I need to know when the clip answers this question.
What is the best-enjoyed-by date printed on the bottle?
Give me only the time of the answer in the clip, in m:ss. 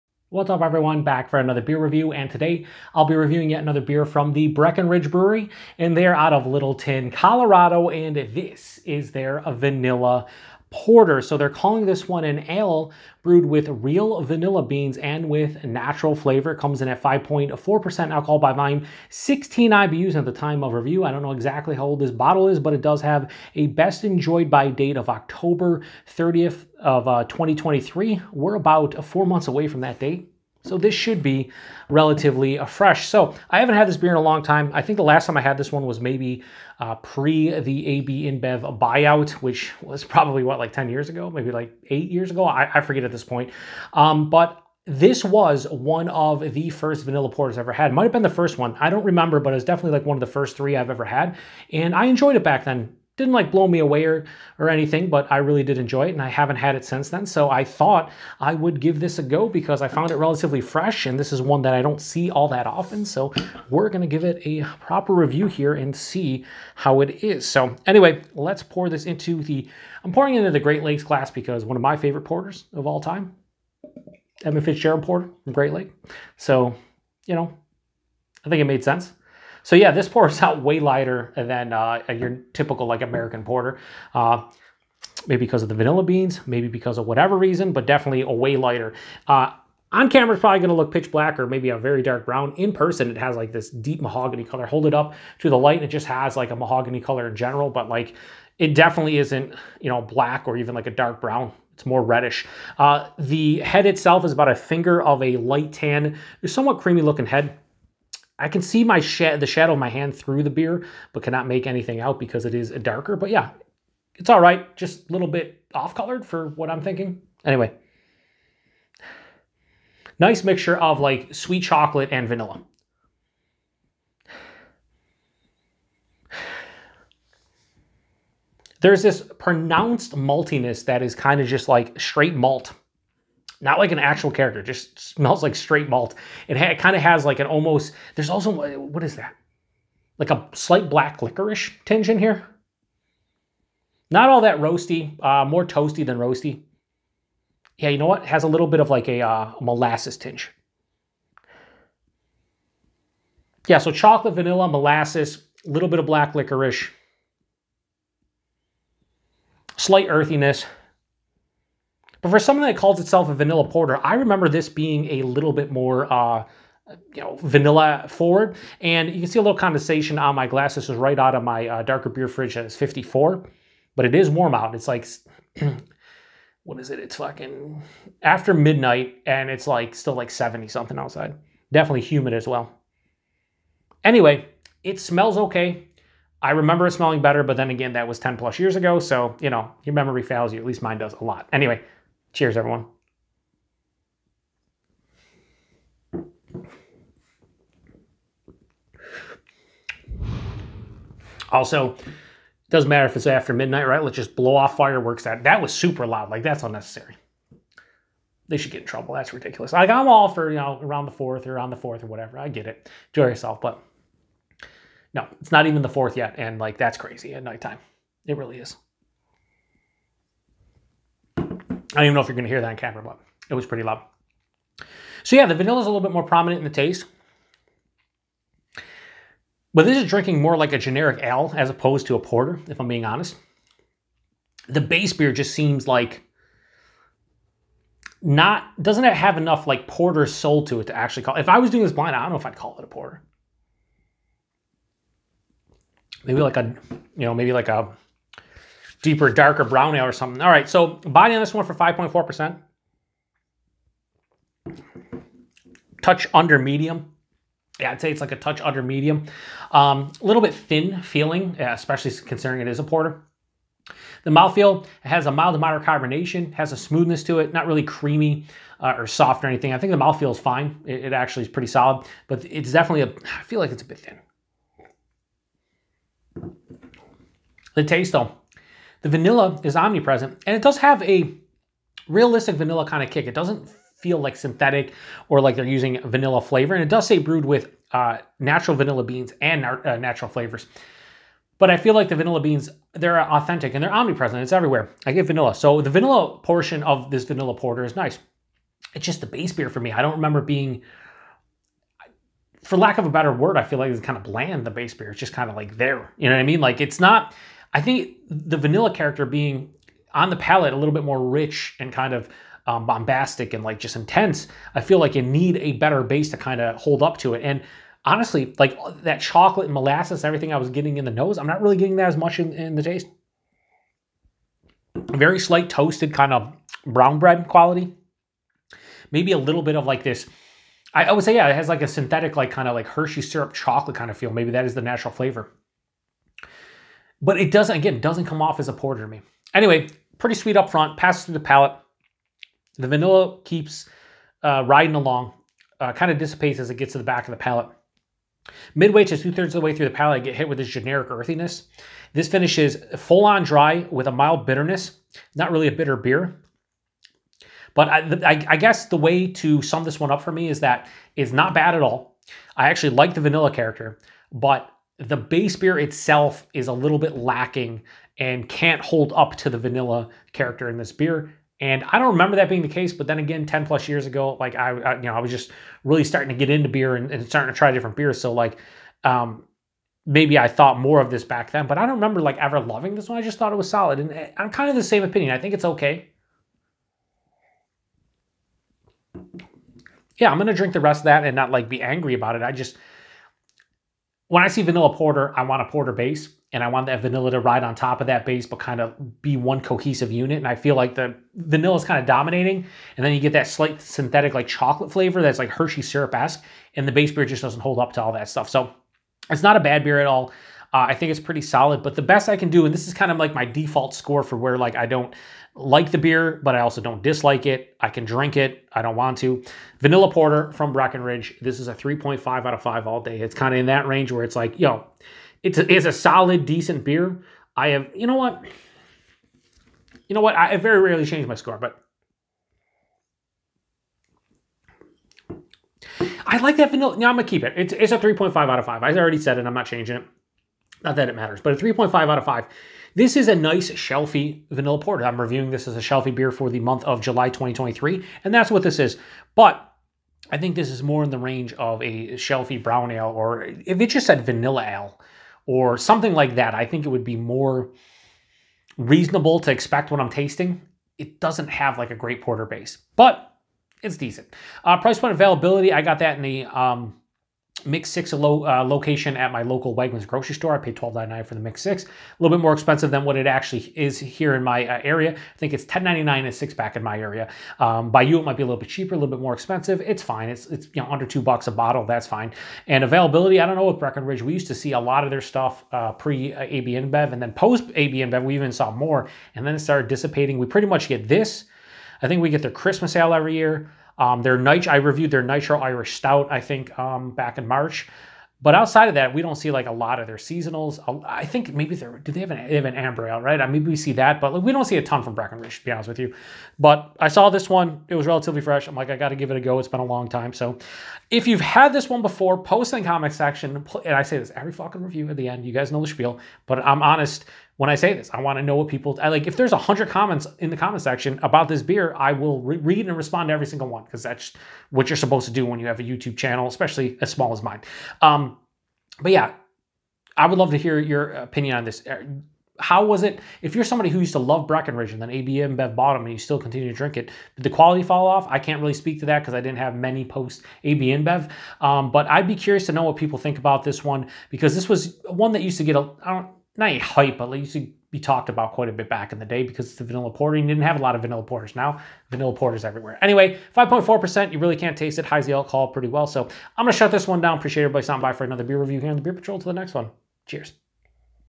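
0:25.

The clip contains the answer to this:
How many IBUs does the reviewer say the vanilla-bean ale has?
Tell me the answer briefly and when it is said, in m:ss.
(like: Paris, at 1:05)
16, at 0:19.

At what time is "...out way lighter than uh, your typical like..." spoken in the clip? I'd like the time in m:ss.
1:20.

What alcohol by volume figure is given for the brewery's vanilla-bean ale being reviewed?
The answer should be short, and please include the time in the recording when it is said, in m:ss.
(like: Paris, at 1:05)
5.4%, at 0:17.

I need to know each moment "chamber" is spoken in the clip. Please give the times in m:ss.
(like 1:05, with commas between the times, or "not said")
not said.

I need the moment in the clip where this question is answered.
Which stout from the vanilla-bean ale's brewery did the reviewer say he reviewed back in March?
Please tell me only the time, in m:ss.
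8:15.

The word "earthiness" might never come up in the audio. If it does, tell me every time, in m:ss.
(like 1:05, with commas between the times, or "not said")
2:40, 5:51.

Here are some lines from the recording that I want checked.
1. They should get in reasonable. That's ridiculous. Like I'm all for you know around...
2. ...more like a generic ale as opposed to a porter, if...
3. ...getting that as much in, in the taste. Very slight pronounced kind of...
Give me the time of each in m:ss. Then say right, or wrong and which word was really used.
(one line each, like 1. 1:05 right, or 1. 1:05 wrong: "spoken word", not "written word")
1. 3:28 wrong: "trouble", not "reasonable"
2. 3:50 right
3. 5:21 wrong: "toasted", not "pronounced".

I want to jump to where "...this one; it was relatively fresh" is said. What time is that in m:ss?
8:27.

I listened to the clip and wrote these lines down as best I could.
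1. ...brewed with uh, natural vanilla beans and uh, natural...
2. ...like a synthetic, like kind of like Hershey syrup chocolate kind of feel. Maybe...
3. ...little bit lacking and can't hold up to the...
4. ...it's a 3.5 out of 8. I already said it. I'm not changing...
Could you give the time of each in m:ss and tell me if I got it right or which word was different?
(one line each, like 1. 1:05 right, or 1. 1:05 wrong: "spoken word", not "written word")
1. 4:47 right
2. 5:31 right
3. 6:06 right
4. 7:17 wrong: "5", not "8".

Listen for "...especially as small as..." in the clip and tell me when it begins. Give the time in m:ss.
8:46.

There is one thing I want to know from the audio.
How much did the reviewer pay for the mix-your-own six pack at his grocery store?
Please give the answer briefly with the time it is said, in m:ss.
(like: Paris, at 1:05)
$12.99, at 7:50.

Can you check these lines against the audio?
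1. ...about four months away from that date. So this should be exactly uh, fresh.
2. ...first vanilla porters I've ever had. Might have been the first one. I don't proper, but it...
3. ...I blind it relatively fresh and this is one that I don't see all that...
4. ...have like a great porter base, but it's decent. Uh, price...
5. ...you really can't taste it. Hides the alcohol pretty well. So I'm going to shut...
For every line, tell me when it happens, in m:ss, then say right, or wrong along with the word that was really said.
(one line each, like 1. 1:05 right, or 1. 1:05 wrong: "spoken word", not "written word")
1. 0:28 wrong: "relatively", not "exactly"
2. 0:46 wrong: "remember", not "proper"
3. 0:59 wrong: "found", not "blind"
4. 7:41 right
5. 9:14 right.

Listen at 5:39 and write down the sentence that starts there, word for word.
Anyway, pretty sweet up front, passes through the palate.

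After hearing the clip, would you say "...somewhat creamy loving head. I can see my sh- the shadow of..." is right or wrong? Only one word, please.
wrong.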